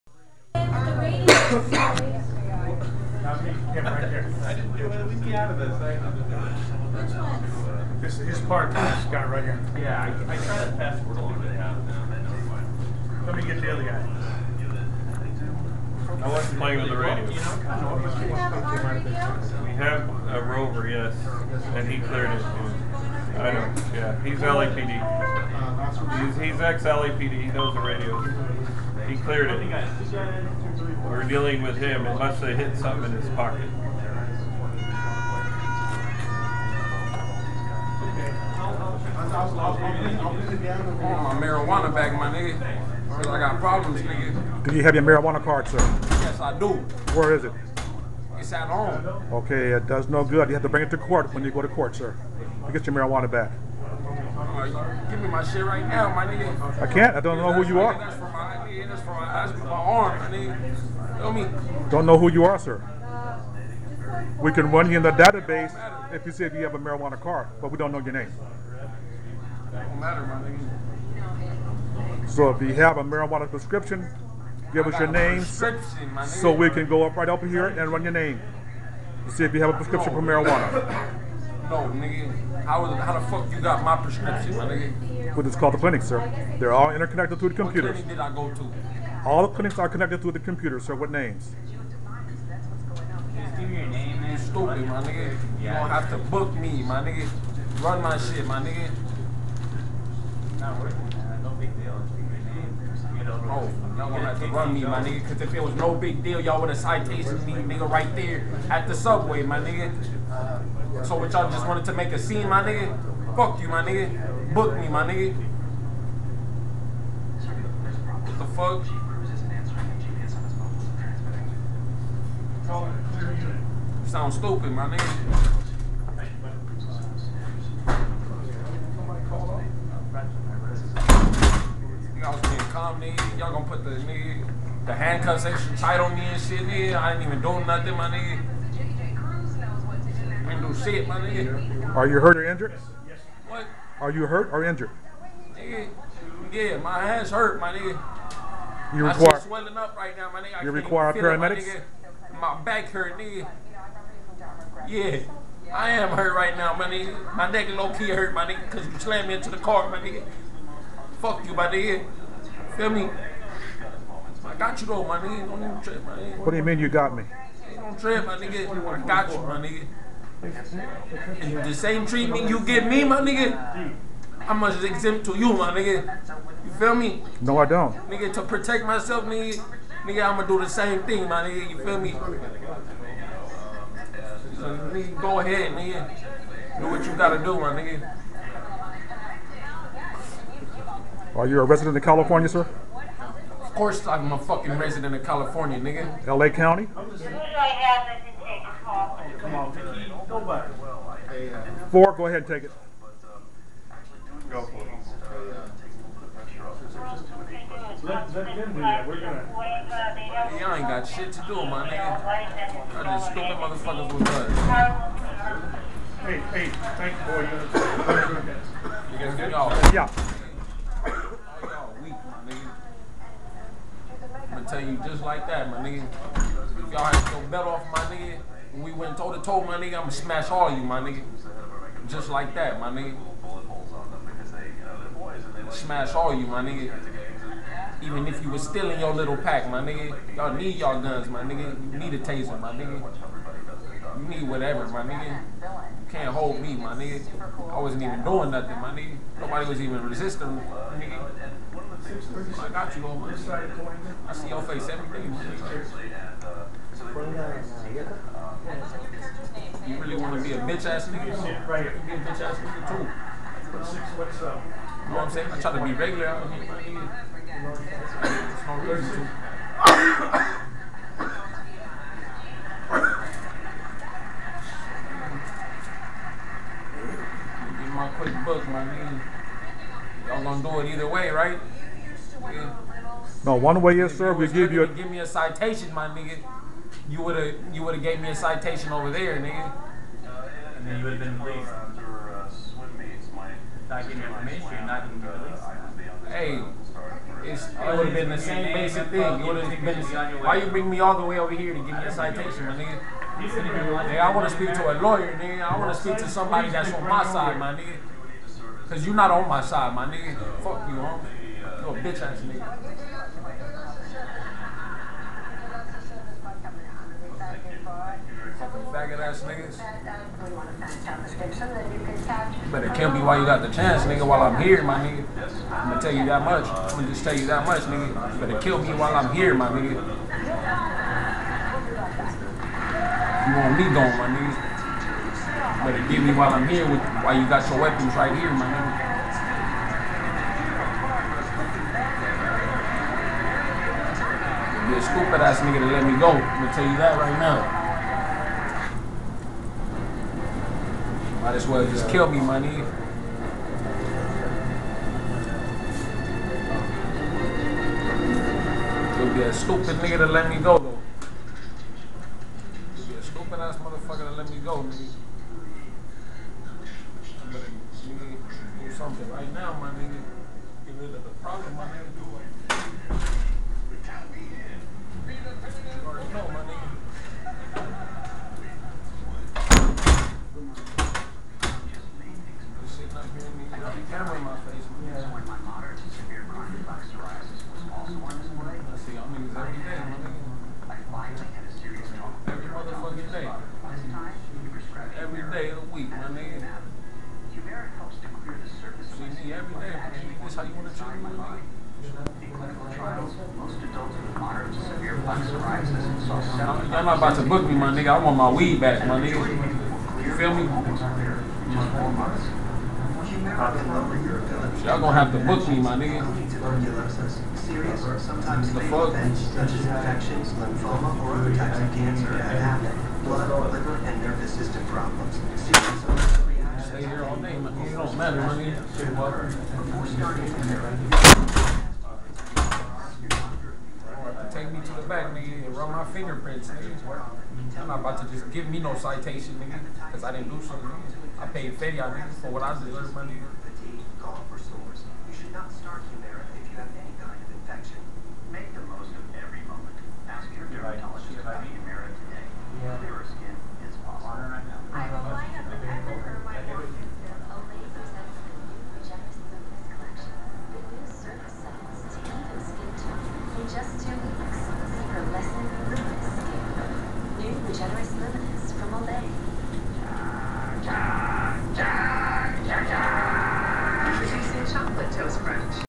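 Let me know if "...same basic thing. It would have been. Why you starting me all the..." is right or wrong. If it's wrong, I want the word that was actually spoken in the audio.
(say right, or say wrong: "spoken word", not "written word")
wrong: "bring", not "starting".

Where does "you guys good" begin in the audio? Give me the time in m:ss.
3:39.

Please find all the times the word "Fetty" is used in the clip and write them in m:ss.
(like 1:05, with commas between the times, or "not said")
7:21.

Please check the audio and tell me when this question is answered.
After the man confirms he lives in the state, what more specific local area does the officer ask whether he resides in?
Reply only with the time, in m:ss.
3:16.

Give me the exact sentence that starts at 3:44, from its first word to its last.
tell you just like that, my nigga.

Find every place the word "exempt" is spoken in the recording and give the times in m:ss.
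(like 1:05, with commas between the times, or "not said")
2:54.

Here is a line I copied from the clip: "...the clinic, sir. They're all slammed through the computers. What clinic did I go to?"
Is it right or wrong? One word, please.
wrong.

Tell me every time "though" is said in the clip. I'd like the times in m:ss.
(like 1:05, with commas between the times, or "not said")
2:44, 6:00.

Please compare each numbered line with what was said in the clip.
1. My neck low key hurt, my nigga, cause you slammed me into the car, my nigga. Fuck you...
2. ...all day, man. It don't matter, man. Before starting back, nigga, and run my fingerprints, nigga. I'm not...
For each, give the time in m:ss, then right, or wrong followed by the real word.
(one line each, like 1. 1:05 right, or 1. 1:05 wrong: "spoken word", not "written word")
1. 2:37 right
2. 7:07 right.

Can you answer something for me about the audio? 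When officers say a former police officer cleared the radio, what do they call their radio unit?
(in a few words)
rover.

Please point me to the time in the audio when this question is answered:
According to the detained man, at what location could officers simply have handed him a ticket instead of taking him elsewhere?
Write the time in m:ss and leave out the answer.
1:48.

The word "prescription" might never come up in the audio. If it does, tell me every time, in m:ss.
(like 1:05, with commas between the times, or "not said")
1:13, 1:19, 1:23.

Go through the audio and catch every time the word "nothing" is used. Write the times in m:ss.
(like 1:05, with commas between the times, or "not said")
2:17, 4:08.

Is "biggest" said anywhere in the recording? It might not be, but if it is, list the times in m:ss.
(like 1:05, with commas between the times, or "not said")
not said.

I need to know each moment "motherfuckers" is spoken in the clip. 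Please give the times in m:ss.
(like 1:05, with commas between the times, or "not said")
3:33, 6:03.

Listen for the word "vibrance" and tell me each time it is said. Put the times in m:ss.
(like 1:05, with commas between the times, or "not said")
not said.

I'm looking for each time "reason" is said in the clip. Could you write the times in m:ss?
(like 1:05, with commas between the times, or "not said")
4:28.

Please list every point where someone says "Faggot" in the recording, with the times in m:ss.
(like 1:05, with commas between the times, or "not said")
5:18.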